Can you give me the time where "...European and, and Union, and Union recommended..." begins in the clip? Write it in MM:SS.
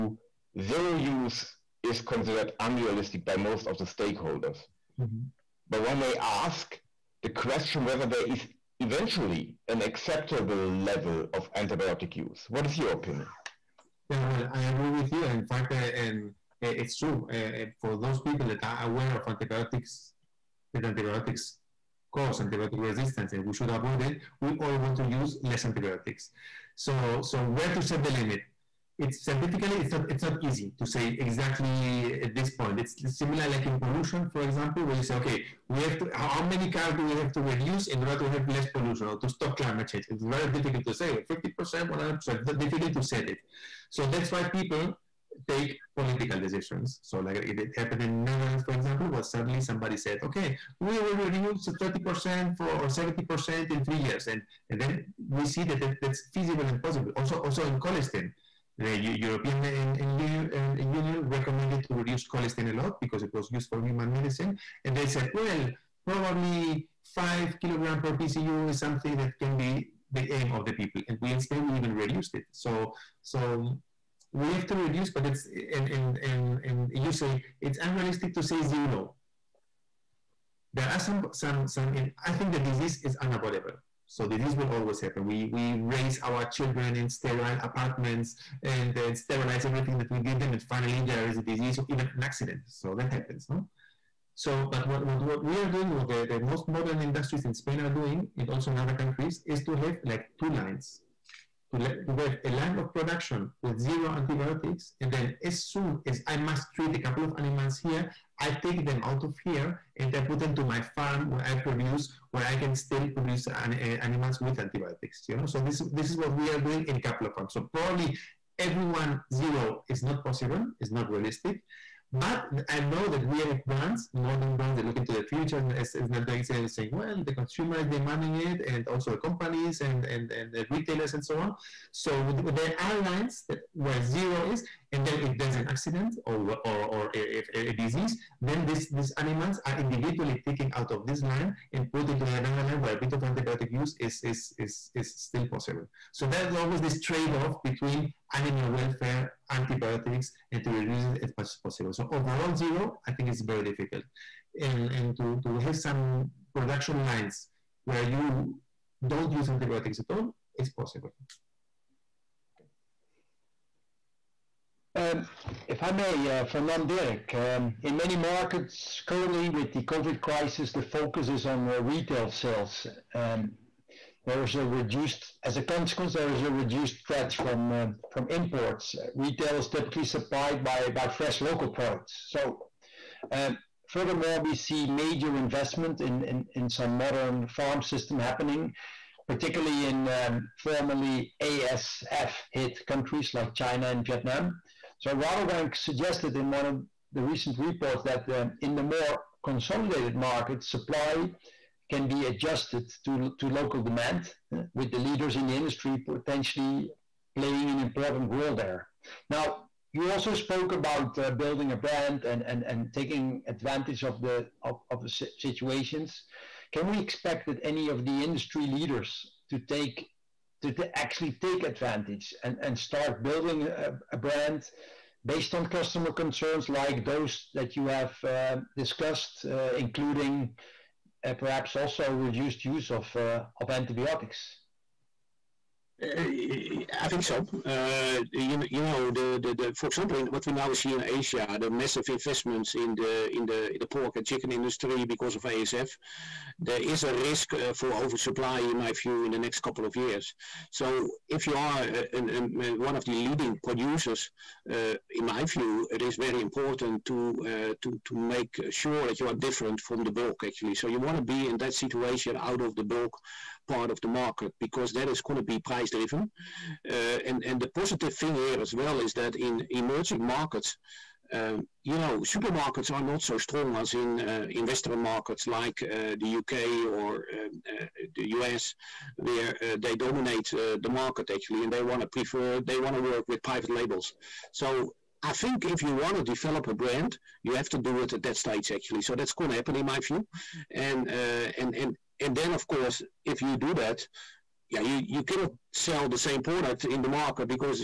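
00:58.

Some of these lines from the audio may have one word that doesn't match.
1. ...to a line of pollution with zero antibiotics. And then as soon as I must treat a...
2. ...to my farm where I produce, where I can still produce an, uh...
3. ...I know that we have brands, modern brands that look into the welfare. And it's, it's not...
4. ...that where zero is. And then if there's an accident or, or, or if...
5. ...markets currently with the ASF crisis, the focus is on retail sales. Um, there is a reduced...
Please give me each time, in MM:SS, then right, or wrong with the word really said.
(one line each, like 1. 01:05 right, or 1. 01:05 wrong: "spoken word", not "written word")
1. 01:42 wrong: "production", not "pollution"
2. 01:50 right
3. 02:02 wrong: "future", not "welfare"
4. 02:13 right
5. 02:48 wrong: "COVID", not "ASF".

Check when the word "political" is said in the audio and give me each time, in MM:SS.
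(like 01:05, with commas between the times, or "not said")
00:45.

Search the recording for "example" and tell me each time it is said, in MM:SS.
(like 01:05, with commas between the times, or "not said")
00:34, 00:48, 03:59.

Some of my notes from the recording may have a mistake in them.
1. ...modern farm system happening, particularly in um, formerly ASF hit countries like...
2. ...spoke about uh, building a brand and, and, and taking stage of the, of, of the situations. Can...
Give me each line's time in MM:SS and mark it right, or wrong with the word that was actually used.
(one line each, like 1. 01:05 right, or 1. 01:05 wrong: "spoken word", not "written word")
1. 03:06 right
2. 03:30 wrong: "advantage", not "stage".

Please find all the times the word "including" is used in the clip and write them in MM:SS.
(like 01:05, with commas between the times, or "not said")
03:49.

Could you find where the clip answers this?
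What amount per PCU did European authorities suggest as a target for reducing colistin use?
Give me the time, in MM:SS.
01:07.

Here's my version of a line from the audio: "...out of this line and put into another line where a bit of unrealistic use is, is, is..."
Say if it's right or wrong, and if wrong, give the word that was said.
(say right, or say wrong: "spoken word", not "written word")
wrong: "antibiotic", not "unrealistic".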